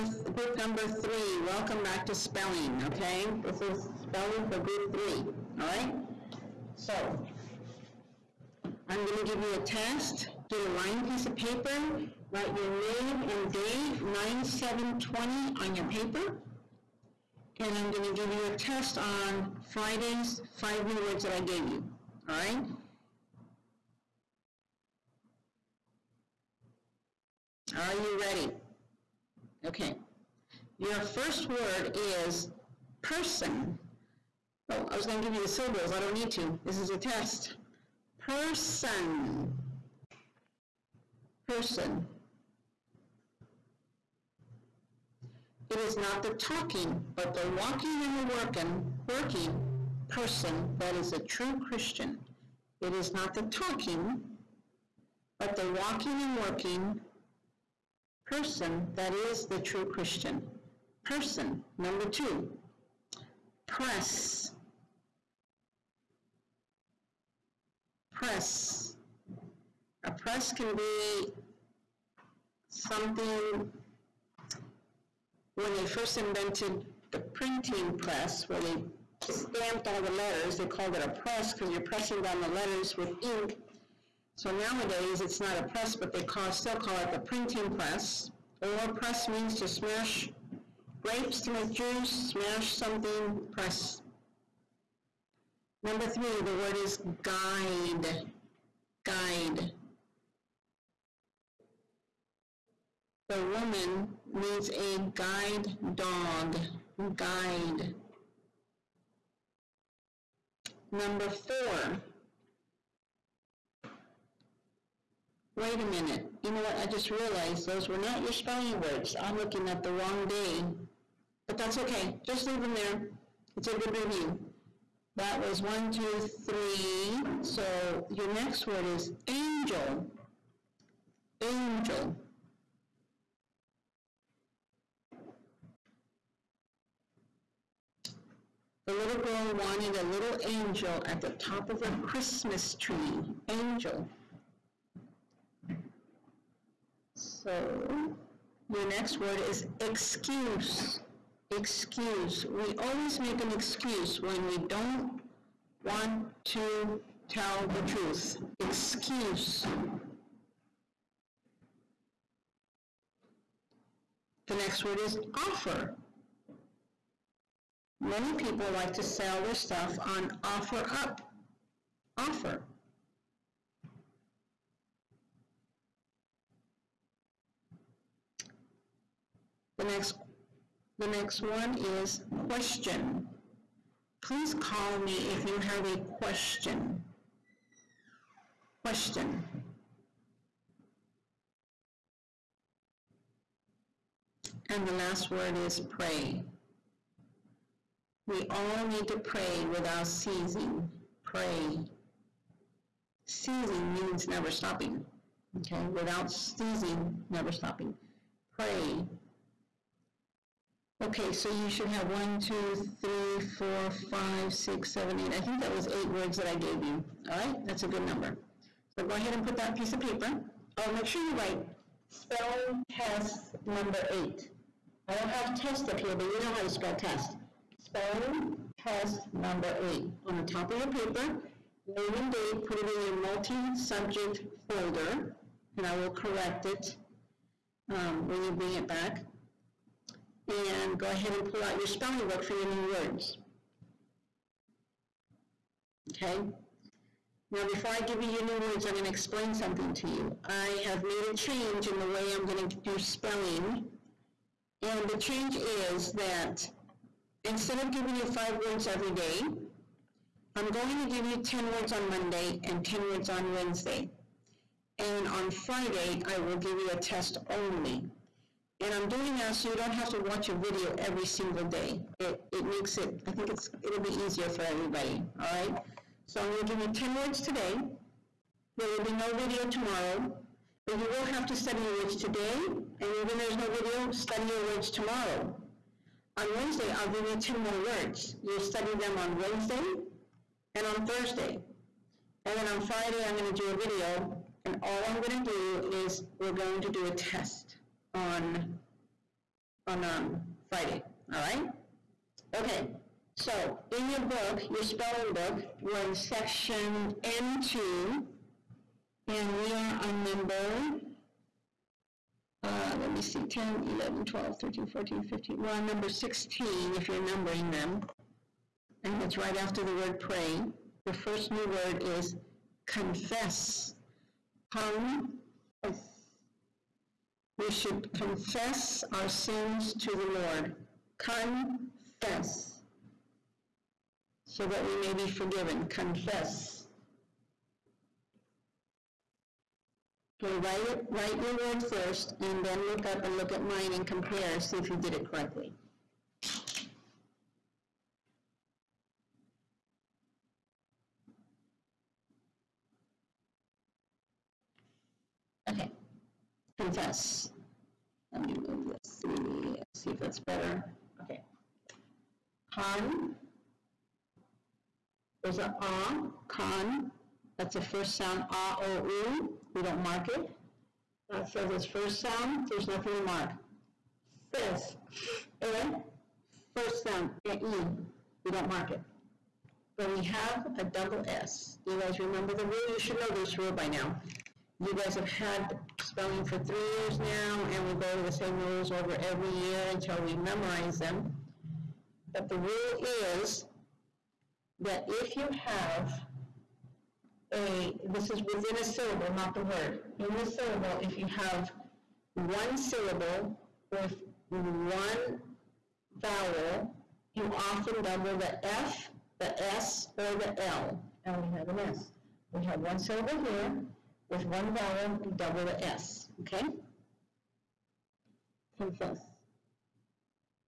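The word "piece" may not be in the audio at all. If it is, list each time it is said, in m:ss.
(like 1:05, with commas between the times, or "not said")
0:11, 3:39.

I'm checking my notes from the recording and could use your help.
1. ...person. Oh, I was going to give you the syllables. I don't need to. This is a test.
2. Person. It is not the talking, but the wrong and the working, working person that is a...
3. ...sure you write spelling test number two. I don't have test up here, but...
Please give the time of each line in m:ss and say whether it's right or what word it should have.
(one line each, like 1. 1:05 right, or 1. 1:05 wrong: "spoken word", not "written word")
1. 0:33 right
2. 0:41 wrong: "walking", not "wrong"
3. 3:41 wrong: "eight", not "two".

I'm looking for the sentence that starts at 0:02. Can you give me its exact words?
Okay, this is spelling for group three.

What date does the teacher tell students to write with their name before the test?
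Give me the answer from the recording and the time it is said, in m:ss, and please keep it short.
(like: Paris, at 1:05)
9720, at 0:14.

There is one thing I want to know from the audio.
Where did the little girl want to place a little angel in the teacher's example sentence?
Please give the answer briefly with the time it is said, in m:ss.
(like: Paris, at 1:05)
top of her Christmas tree, at 2:21.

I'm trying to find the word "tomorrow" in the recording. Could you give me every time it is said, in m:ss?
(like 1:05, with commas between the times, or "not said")
4:39, 4:44.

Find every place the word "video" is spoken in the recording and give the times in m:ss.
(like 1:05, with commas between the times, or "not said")
4:30, 4:39, 4:43, 4:53.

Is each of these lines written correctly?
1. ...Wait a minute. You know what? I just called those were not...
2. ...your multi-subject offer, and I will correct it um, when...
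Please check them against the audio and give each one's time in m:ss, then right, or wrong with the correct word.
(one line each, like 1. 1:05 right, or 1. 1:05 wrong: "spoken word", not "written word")
1. 1:55 wrong: "realized", not "called"
2. 3:52 wrong: "folder", not "offer".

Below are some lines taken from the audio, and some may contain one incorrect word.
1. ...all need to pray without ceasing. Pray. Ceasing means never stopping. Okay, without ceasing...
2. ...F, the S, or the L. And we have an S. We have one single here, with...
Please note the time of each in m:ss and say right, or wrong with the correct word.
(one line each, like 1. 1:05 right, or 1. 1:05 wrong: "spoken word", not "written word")
1. 3:18 right
2. 6:48 wrong: "syllable", not "single".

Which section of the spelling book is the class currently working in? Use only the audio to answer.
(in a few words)
N2.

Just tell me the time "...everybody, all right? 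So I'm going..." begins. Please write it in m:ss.
4:34.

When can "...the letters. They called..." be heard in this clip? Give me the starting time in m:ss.
1:20.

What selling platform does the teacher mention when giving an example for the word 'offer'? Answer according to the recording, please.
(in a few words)
OfferUp.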